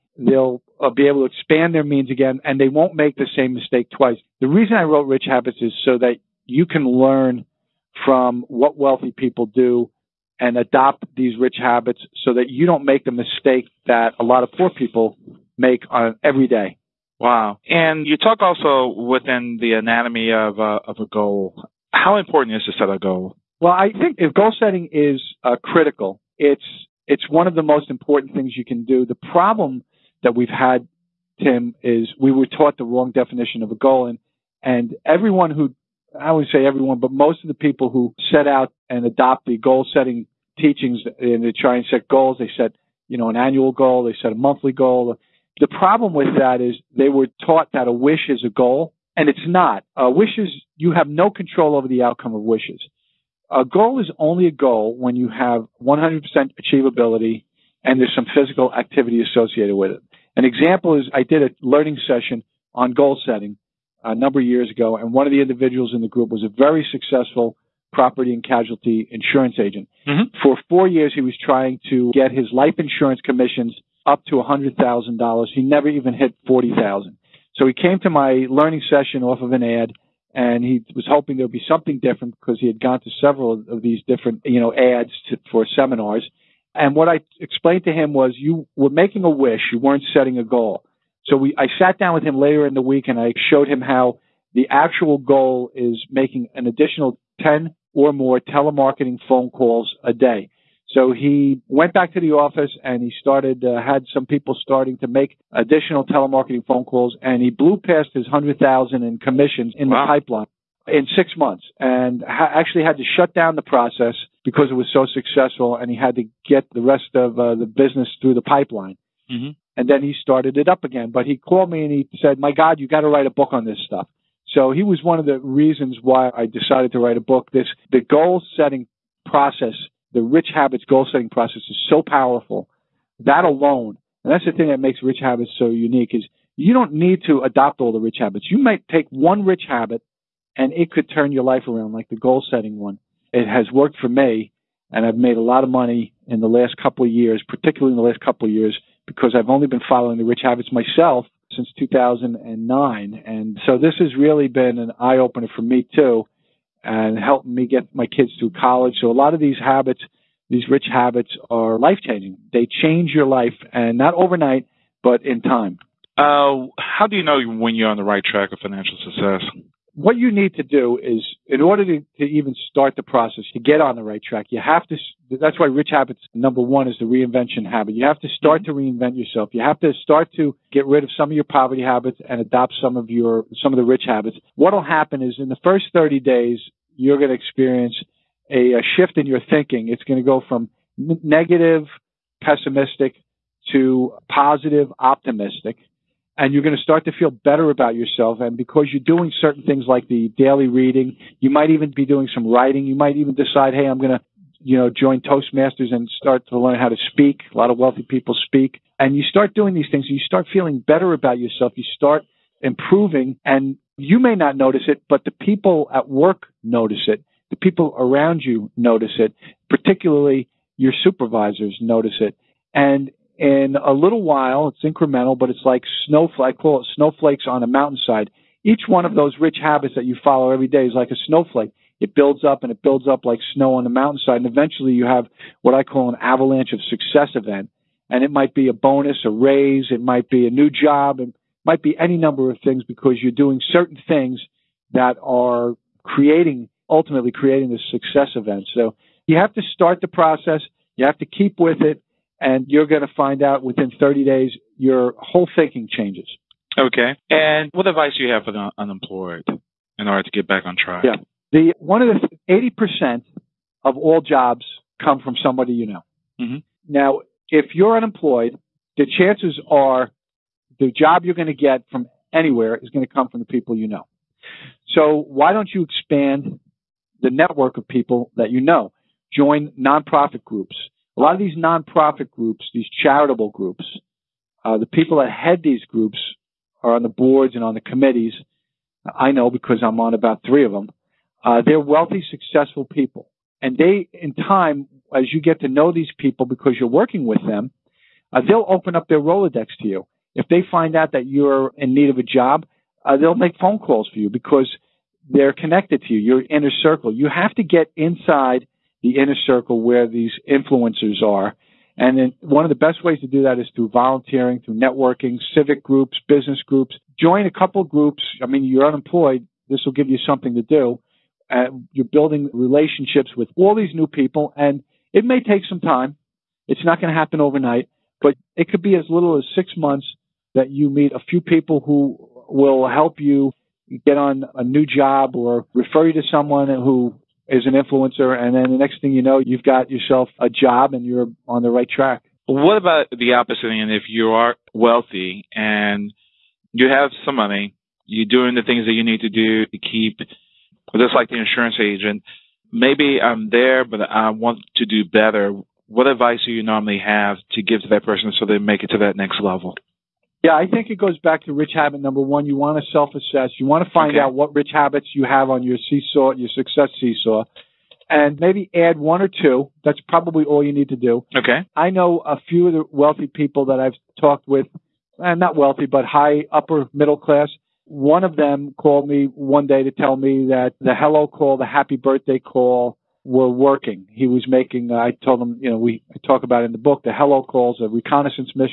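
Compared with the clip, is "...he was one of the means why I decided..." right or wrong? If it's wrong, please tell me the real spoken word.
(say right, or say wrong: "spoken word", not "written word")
wrong: "reasons", not "means".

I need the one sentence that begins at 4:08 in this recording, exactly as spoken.
So you have to start the process.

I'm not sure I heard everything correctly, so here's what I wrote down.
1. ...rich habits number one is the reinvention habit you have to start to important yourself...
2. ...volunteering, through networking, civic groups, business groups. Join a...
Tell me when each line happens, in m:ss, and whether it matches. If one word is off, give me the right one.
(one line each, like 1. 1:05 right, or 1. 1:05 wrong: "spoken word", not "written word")
1. 2:55 wrong: "reinvent", not "important"
2. 5:13 right.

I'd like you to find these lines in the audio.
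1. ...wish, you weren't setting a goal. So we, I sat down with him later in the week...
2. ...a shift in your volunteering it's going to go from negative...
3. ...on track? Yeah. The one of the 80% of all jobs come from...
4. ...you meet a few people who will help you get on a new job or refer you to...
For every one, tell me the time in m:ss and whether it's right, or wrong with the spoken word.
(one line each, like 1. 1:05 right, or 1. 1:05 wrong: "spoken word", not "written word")
1. 1:29 right
2. 3:08 wrong: "thinking", not "volunteering"
3. 4:20 right
4. 5:30 right.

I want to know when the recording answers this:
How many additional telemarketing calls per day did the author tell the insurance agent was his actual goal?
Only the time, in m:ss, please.
1:37.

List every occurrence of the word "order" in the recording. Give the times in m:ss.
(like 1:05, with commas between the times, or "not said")
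2:51, 4:20.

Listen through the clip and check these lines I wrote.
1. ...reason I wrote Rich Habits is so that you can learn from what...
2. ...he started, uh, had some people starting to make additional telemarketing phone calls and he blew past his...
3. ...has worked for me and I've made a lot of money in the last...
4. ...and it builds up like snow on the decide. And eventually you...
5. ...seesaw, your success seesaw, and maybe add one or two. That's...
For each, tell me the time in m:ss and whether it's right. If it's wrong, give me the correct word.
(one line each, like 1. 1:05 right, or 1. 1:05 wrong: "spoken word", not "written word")
1. 0:04 right
2. 1:43 right
3. 2:23 right
4. 3:52 wrong: "mountainside", not "decide"
5. 6:05 right.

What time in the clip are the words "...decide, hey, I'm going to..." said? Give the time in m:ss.
3:23.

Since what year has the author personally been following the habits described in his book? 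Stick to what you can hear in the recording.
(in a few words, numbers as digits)
2009.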